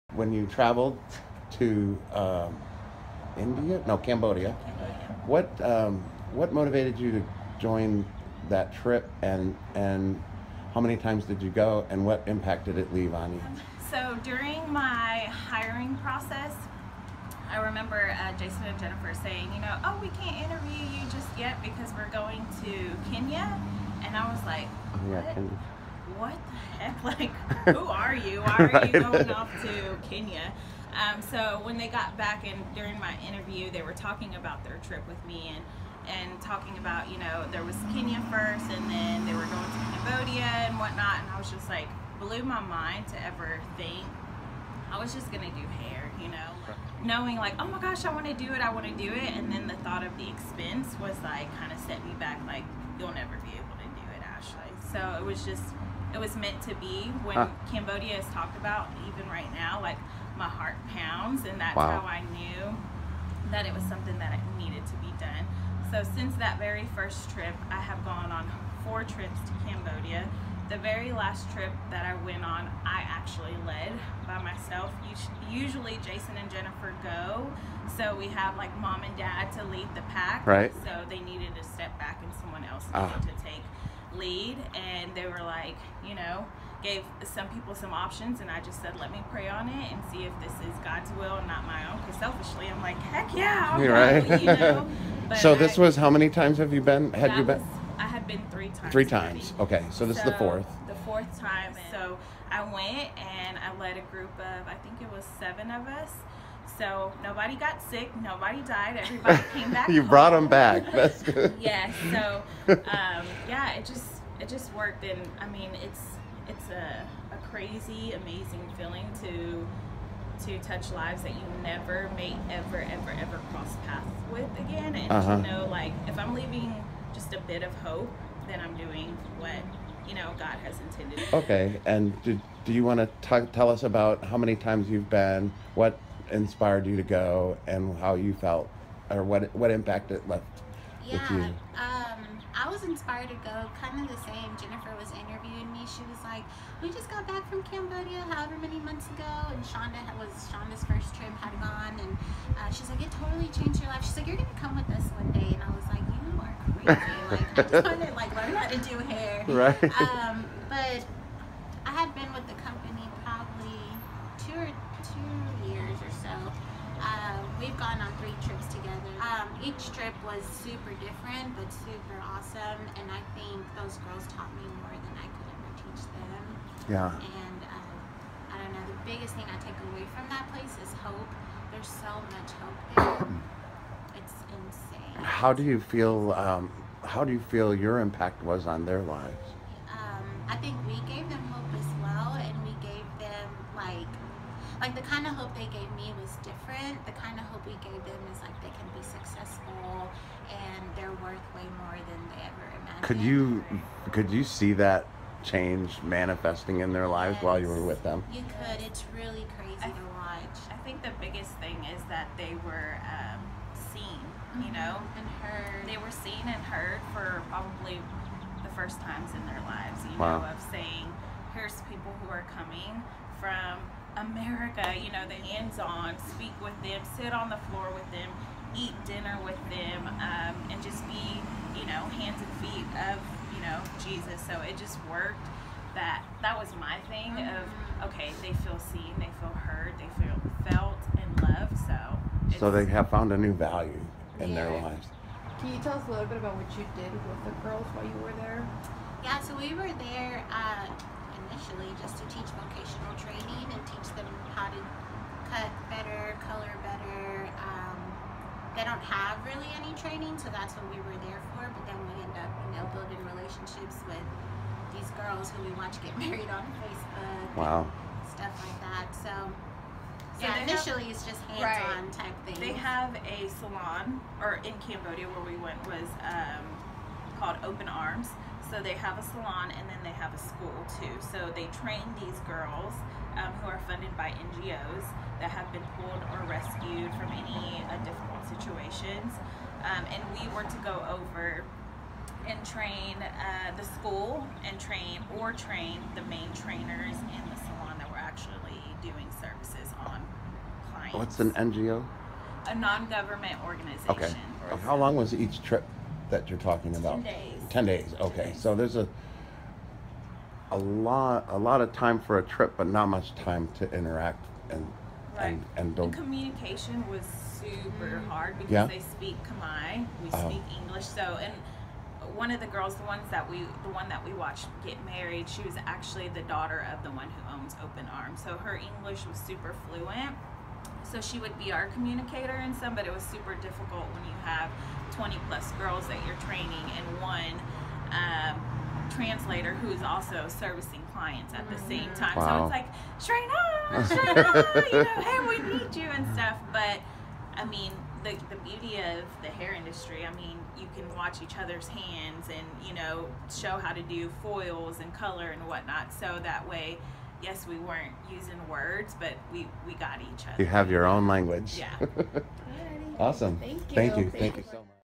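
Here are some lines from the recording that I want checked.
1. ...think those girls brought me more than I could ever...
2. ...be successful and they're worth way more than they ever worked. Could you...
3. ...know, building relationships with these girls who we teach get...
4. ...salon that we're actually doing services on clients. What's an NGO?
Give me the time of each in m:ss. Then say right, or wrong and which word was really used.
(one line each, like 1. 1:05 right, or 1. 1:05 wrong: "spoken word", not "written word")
1. 2:53 wrong: "taught", not "brought"
2. 3:18 wrong: "imagined", not "worked"
3. 4:22 wrong: "watch", not "teach"
4. 4:57 right.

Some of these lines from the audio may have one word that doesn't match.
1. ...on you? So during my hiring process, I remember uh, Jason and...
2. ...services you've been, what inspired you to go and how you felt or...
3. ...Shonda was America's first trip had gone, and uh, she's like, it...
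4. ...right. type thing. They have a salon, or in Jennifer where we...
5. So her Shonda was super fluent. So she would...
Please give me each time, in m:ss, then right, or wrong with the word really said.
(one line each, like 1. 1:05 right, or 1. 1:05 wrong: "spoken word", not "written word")
1. 0:13 right
2. 2:14 wrong: "times", not "services"
3. 2:29 wrong: "Shonda", not "America"
4. 4:32 wrong: "Cambodia", not "Jennifer"
5. 5:28 wrong: "English", not "Shonda".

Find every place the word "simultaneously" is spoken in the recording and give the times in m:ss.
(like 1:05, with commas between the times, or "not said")
not said.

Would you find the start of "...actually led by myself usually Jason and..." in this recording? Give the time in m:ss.
1:13.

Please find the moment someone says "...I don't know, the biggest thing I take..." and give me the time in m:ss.
2:58.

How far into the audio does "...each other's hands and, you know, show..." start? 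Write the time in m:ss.
5:51.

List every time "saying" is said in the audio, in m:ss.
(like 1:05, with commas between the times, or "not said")
0:19, 3:40.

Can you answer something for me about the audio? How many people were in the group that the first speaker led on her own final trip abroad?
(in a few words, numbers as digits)
7.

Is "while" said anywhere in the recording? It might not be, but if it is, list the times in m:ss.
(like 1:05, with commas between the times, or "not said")
3:27, 4:07.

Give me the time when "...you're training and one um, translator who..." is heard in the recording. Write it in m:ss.
5:36.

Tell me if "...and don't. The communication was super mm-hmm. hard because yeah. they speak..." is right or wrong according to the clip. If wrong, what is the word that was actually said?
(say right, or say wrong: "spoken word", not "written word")
right.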